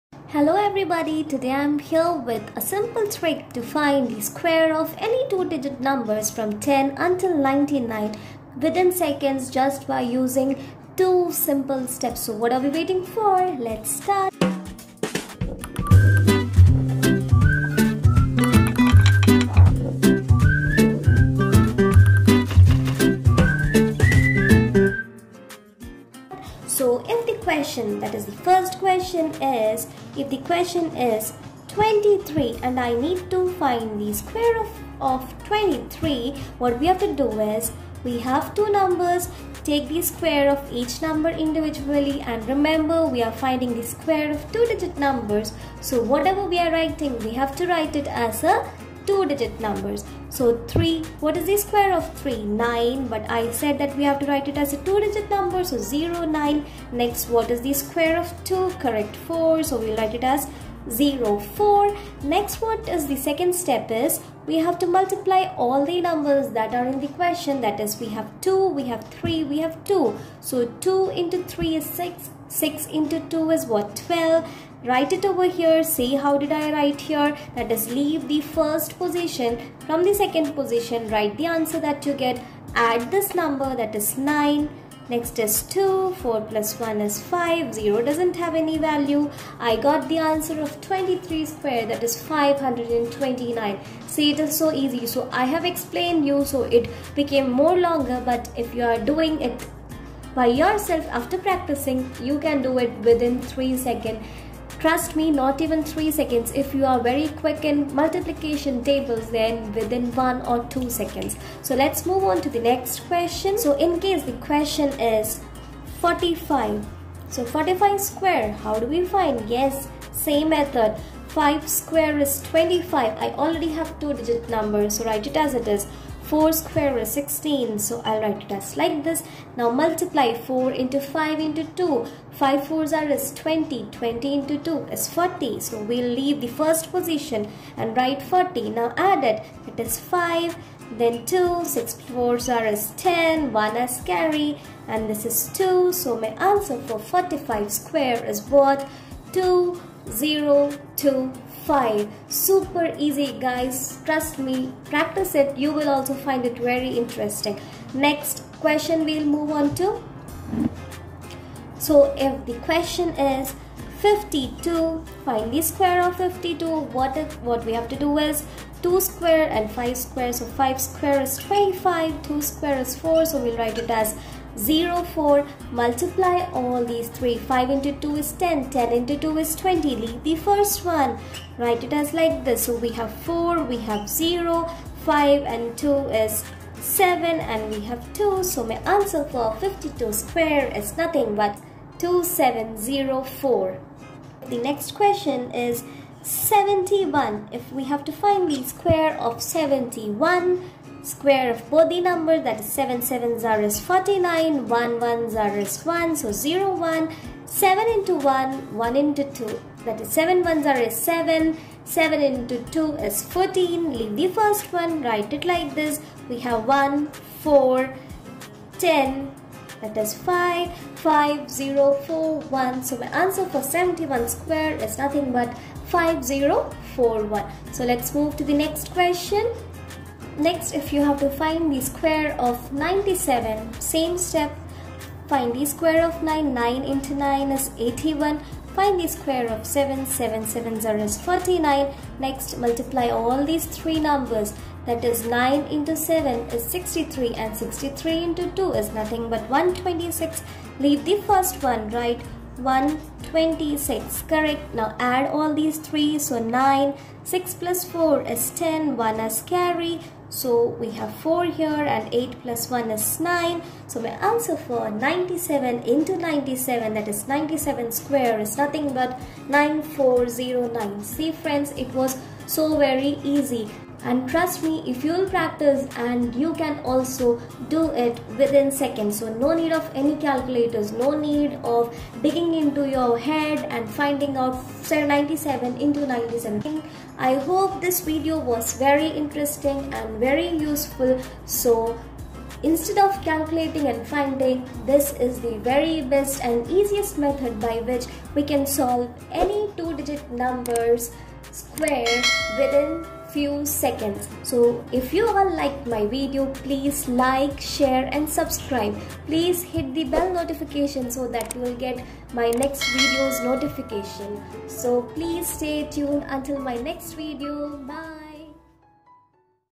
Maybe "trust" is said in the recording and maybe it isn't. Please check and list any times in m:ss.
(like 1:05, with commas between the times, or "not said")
1:44, 2:34, 4:34.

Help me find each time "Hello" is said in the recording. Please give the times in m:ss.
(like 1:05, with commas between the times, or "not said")
0:00.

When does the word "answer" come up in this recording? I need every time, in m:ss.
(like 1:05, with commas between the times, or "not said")
1:21, 1:30, 2:26, 3:08, 3:43, 4:24.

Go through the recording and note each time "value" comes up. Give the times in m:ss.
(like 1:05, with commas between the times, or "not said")
1:28.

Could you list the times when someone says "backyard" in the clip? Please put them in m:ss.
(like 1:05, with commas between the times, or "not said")
not said.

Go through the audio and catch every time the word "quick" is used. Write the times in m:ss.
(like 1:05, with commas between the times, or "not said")
1:47.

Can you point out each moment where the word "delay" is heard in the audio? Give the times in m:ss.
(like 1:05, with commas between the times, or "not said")
not said.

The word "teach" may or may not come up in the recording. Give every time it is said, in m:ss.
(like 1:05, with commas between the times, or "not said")
not said.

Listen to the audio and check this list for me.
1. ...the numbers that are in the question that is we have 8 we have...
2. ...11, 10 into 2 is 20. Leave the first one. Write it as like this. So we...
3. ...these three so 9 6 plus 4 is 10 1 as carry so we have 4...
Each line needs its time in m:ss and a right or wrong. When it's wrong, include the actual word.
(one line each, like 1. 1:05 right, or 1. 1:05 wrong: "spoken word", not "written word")
1. 1:05 wrong: "2", not "8"
2. 2:58 wrong: "10", not "11"
3. 4:15 right.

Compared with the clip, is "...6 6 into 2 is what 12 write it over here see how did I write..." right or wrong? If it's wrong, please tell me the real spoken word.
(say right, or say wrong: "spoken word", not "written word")
right.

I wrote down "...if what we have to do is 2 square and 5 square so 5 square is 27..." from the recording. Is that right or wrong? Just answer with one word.
wrong.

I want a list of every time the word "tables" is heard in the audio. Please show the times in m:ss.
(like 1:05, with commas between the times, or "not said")
1:48.